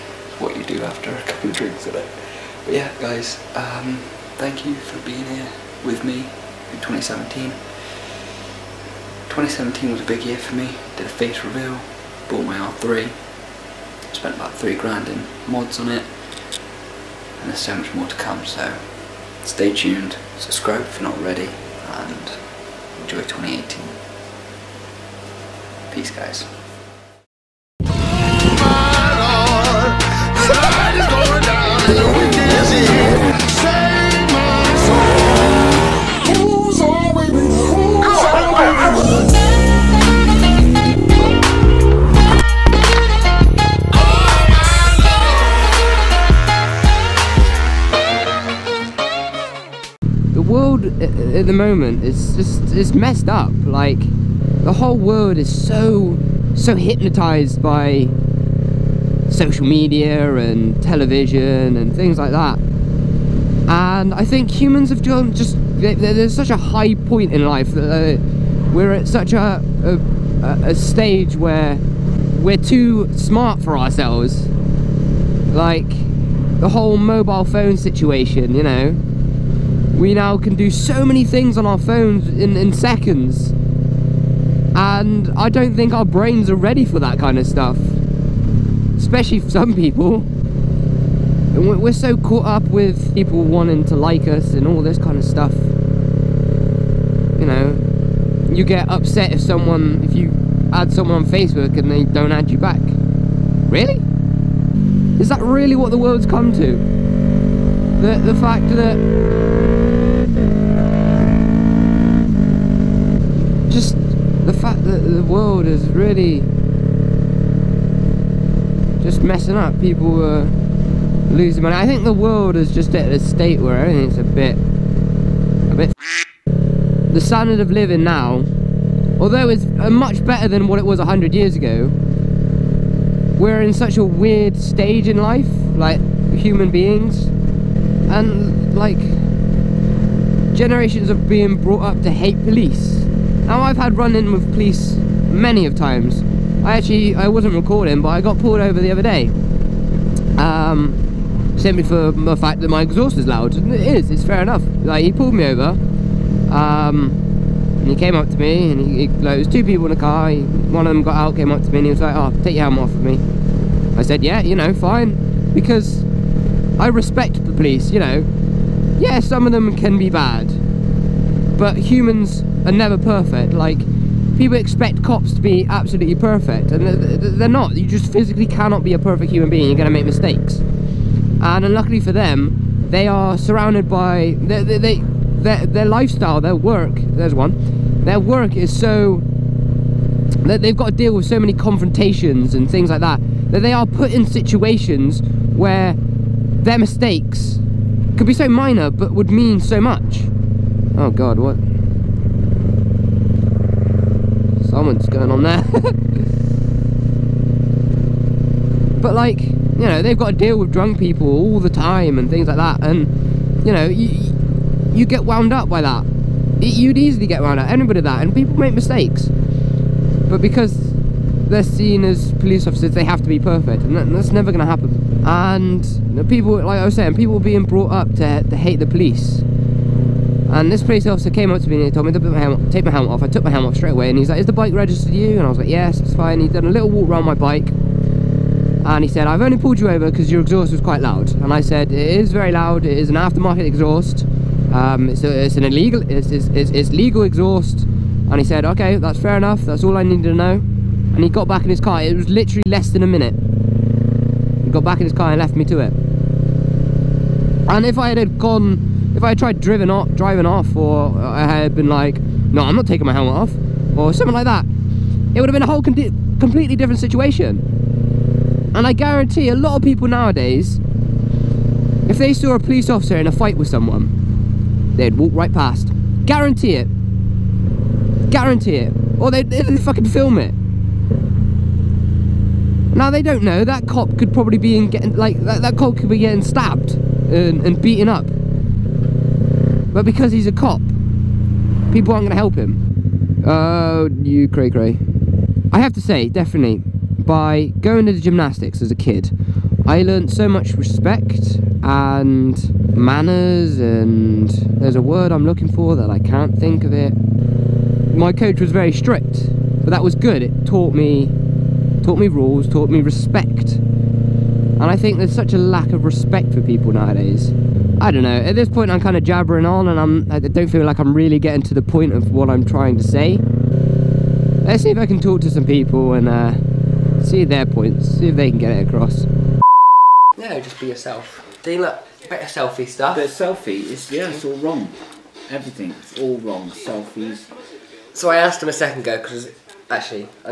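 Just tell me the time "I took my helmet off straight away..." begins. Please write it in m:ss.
3:53.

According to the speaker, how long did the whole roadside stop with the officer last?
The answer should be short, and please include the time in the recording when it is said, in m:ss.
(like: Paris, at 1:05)
less than a minute, at 4:12.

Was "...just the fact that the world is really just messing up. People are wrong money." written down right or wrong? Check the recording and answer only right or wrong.
wrong.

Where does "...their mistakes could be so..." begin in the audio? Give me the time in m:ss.
3:15.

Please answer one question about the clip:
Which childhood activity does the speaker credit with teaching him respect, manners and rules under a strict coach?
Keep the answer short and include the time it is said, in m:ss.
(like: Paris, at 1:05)
gymnastics, at 4:58.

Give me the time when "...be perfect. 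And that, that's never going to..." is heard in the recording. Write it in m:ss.
3:43.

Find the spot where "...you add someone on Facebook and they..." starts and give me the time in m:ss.
1:40.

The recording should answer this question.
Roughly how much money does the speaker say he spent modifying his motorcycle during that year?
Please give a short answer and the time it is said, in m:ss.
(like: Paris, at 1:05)
3 grand, at 0:14.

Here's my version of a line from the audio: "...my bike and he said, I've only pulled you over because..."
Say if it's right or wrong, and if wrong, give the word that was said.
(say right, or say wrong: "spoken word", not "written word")
right.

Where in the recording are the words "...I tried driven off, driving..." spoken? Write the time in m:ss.
4:19.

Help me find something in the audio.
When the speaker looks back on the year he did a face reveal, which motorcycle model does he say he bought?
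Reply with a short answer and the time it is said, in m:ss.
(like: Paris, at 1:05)
R3, at 0:12.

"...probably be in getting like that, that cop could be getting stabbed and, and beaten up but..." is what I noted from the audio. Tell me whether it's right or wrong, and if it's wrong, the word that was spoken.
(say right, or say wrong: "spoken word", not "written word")
right.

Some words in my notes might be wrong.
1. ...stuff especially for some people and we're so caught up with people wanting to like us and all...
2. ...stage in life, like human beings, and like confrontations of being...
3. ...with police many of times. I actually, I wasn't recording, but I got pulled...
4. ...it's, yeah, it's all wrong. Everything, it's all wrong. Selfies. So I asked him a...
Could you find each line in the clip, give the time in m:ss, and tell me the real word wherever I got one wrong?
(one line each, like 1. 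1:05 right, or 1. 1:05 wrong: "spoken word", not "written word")
1. 1:27 right
2. 2:14 wrong: "generations", not "confrontations"
3. 2:24 right
4. 5:33 right.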